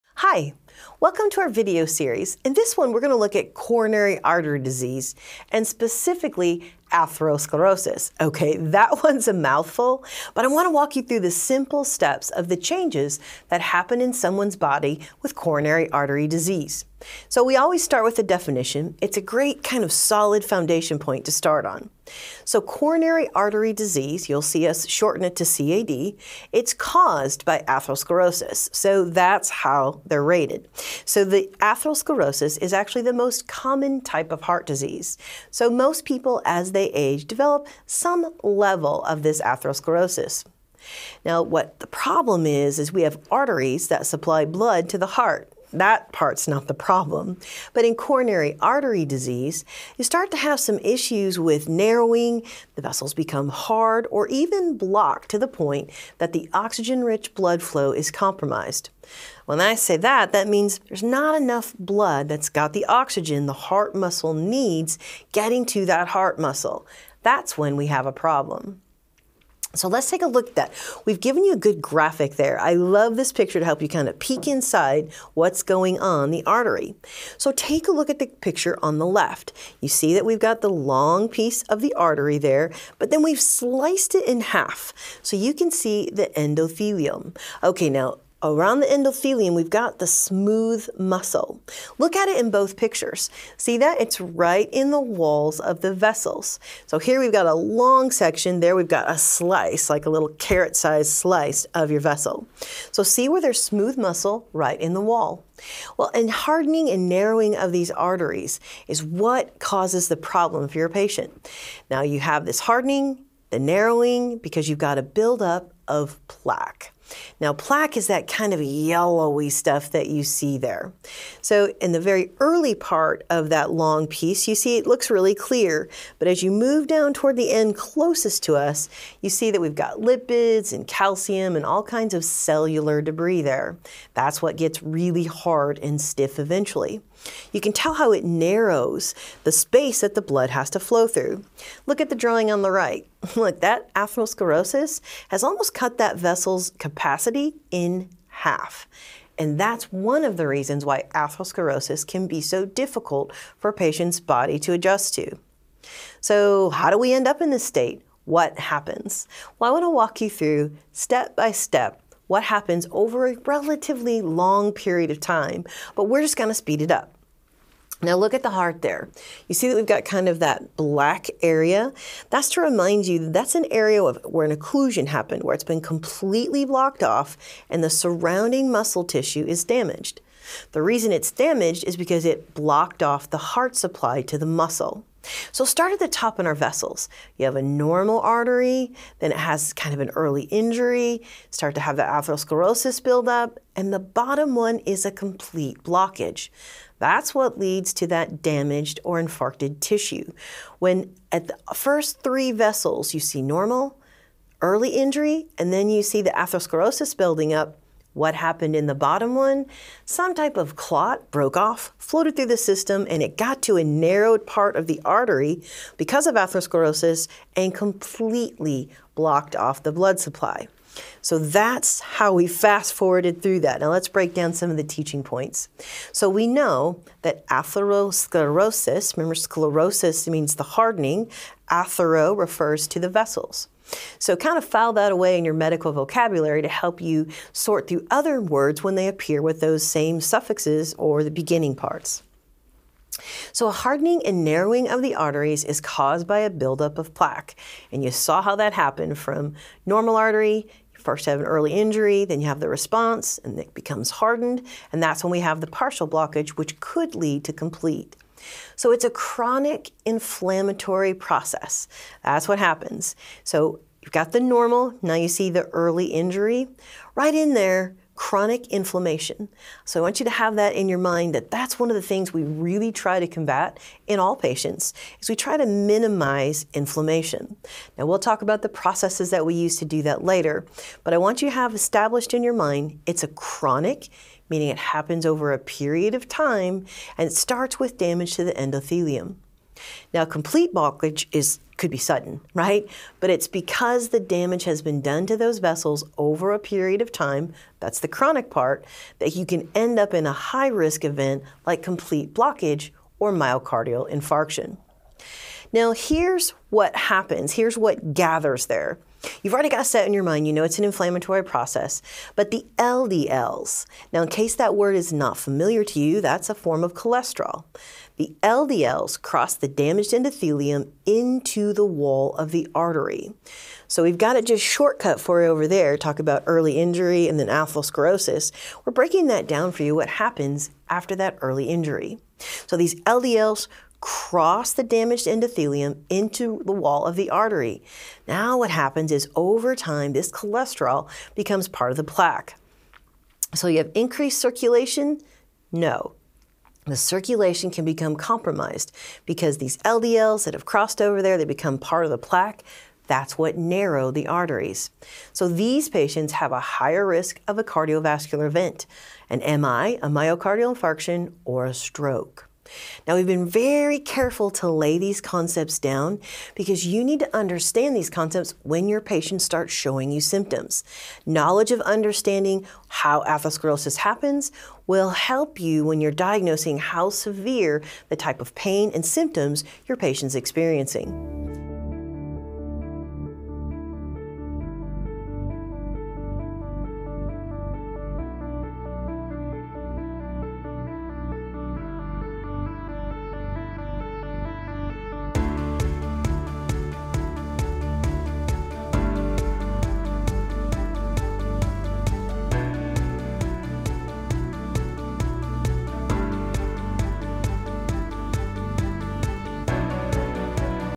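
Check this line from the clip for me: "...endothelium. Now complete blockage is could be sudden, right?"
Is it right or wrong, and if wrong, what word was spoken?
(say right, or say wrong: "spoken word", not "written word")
right.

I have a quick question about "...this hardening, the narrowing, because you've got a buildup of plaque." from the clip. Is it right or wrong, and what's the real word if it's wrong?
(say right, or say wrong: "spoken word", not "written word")
right.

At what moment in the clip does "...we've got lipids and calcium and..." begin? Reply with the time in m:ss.
2:09.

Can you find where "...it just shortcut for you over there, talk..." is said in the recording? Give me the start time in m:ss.
5:24.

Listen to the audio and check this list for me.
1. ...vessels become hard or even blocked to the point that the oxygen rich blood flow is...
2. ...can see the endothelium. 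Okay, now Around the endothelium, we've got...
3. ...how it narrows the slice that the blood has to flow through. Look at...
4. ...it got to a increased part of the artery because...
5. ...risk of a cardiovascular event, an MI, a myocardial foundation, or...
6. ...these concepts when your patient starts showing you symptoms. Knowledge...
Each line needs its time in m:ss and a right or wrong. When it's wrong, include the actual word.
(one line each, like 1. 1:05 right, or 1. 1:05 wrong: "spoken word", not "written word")
1. 0:52 right
2. 1:25 right
3. 2:17 wrong: "space", not "slice"
4. 3:33 wrong: "narrowed", not "increased"
5. 5:57 wrong: "infarction", not "foundation"
6. 6:07 right.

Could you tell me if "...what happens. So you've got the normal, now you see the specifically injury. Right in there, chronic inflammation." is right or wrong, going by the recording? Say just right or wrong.
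wrong.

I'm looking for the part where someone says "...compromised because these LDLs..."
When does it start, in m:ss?
5:48.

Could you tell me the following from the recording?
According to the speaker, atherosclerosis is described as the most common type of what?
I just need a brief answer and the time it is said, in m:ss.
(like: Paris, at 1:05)
heart disease, at 0:34.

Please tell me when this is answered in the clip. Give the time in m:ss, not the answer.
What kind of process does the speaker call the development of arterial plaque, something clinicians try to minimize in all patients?
4:19.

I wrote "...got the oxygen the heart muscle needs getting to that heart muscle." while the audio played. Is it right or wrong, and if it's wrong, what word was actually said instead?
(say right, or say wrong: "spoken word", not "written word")
right.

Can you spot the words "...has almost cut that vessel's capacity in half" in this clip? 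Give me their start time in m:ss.
2:25.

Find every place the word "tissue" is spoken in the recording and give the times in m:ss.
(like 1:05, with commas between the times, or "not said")
2:59, 3:19.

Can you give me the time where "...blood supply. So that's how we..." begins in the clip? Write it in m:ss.
3:39.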